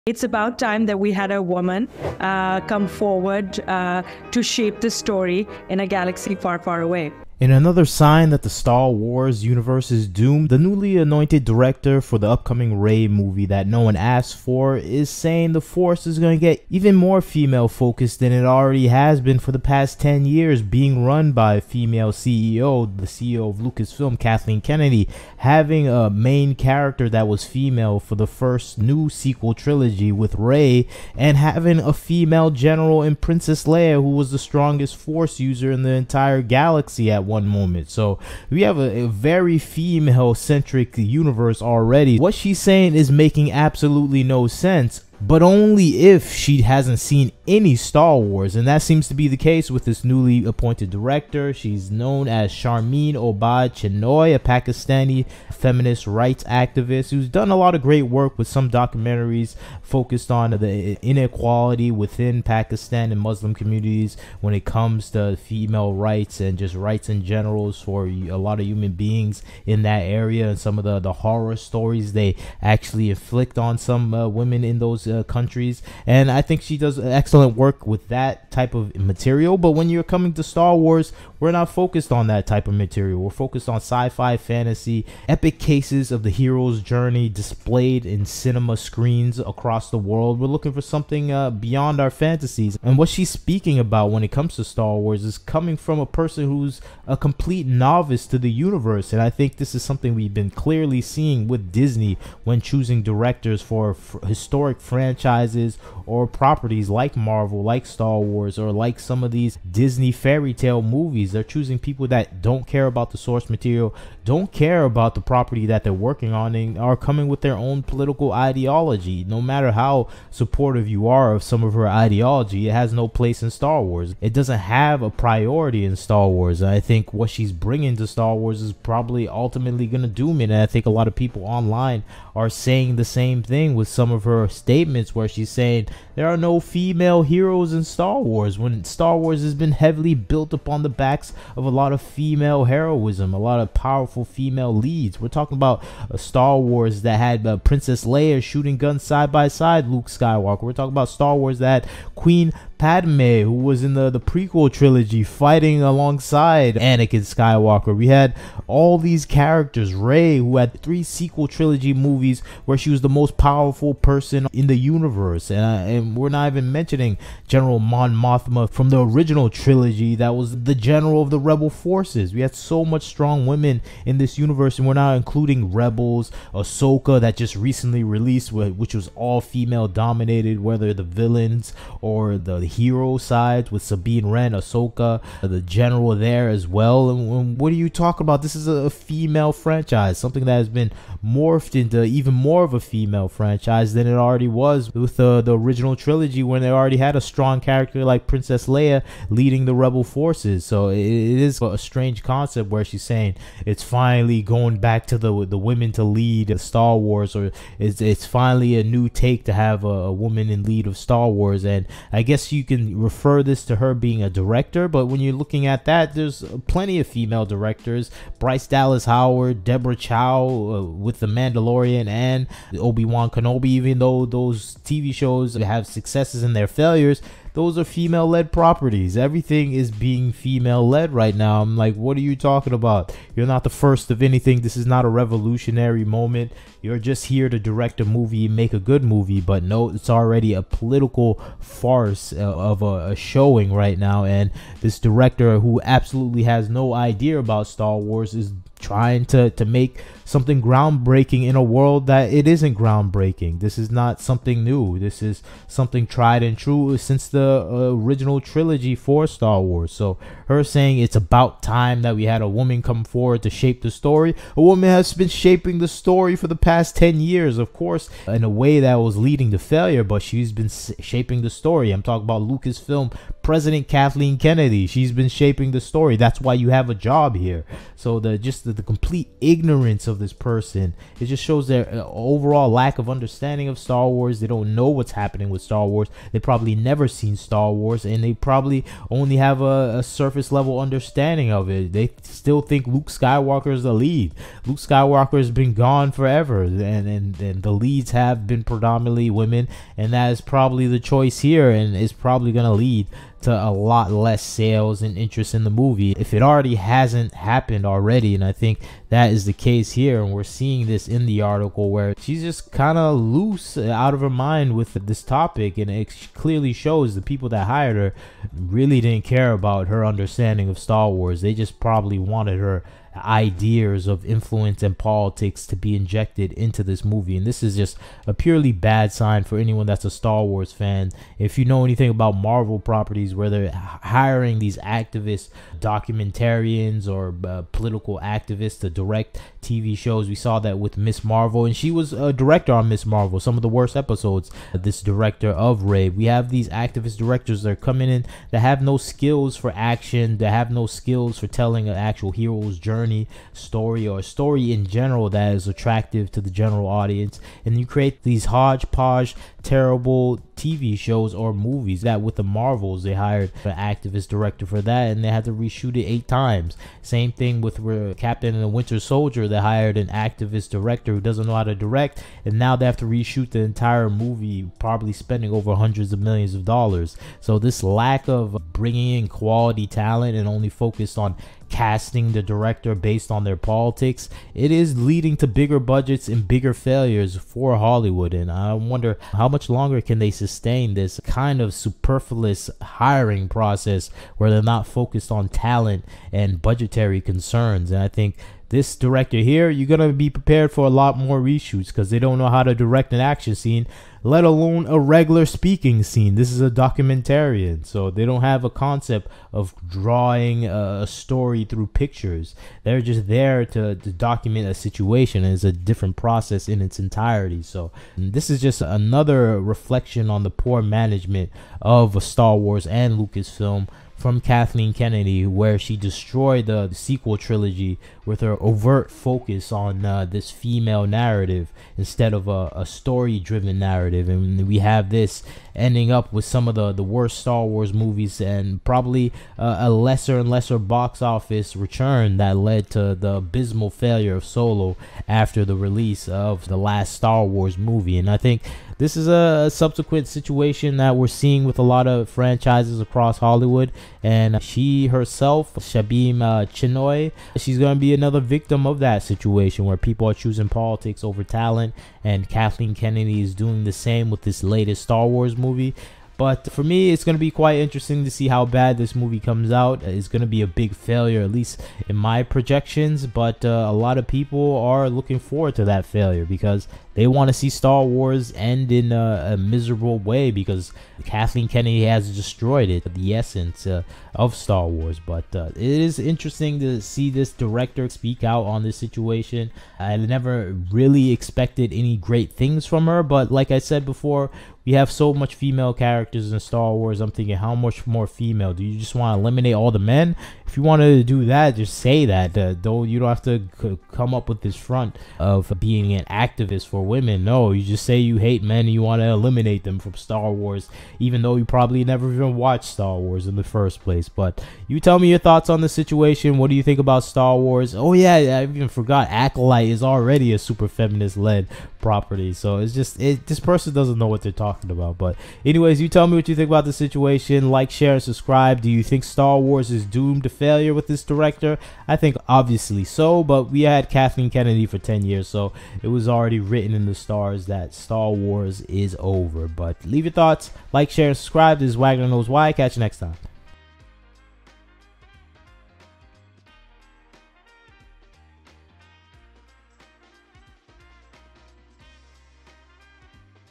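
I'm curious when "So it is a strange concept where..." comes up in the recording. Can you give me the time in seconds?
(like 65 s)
200 s.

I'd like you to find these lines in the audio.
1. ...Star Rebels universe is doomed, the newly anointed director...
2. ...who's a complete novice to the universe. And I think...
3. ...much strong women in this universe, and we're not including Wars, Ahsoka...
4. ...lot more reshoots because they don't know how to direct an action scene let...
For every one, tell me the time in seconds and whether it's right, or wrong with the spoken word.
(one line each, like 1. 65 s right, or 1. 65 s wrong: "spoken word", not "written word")
1. 8 s wrong: "Wars", not "Rebels"
2. 96 s right
3. 172 s wrong: "Rebels", not "Wars"
4. 400 s right.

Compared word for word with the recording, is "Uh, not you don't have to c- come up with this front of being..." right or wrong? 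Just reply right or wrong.
right.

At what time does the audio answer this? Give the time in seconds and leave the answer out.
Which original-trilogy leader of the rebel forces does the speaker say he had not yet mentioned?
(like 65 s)
167 s.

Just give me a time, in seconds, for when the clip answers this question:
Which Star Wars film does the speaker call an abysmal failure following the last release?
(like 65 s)
444 s.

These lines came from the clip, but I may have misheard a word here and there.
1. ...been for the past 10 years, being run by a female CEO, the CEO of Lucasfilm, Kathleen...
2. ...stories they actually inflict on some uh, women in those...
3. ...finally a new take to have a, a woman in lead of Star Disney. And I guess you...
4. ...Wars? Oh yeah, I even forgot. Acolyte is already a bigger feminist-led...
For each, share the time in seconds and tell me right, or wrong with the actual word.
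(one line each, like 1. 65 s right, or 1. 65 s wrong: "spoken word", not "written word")
1. 19 s right
2. 71 s right
3. 208 s wrong: "Wars", not "Disney"
4. 517 s wrong: "super", not "bigger".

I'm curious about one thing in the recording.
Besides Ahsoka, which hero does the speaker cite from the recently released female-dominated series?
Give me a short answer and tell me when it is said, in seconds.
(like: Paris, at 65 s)
Sabine Wren, at 183 s.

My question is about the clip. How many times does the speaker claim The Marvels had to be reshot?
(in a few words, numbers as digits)
8.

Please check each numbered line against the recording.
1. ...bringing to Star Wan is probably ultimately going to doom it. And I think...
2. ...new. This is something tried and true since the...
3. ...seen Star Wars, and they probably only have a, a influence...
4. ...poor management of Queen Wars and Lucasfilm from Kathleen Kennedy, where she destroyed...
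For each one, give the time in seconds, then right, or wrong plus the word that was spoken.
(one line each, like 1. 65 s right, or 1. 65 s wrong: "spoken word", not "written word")
1. 127 s wrong: "Wars", not "Wan"
2. 254 s right
3. 287 s wrong: "surface", not "influence"
4. 420 s wrong: "Star", not "Queen".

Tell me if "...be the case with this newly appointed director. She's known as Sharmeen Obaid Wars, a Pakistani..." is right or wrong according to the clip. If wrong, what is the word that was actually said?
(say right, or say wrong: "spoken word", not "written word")
wrong: "Chinoy", not "Wars".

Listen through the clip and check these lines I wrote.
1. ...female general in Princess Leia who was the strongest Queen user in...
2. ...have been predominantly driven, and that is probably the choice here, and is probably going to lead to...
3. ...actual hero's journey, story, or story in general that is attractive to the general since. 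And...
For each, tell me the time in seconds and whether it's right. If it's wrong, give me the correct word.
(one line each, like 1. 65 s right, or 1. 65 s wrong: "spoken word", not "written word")
1. 31 s wrong: "Force", not "Queen"
2. 298 s wrong: "women", not "driven"
3. 351 s wrong: "audience", not "since".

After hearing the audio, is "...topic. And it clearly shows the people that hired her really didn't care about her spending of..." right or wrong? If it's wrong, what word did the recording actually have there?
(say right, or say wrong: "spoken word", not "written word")
wrong: "understanding", not "spending".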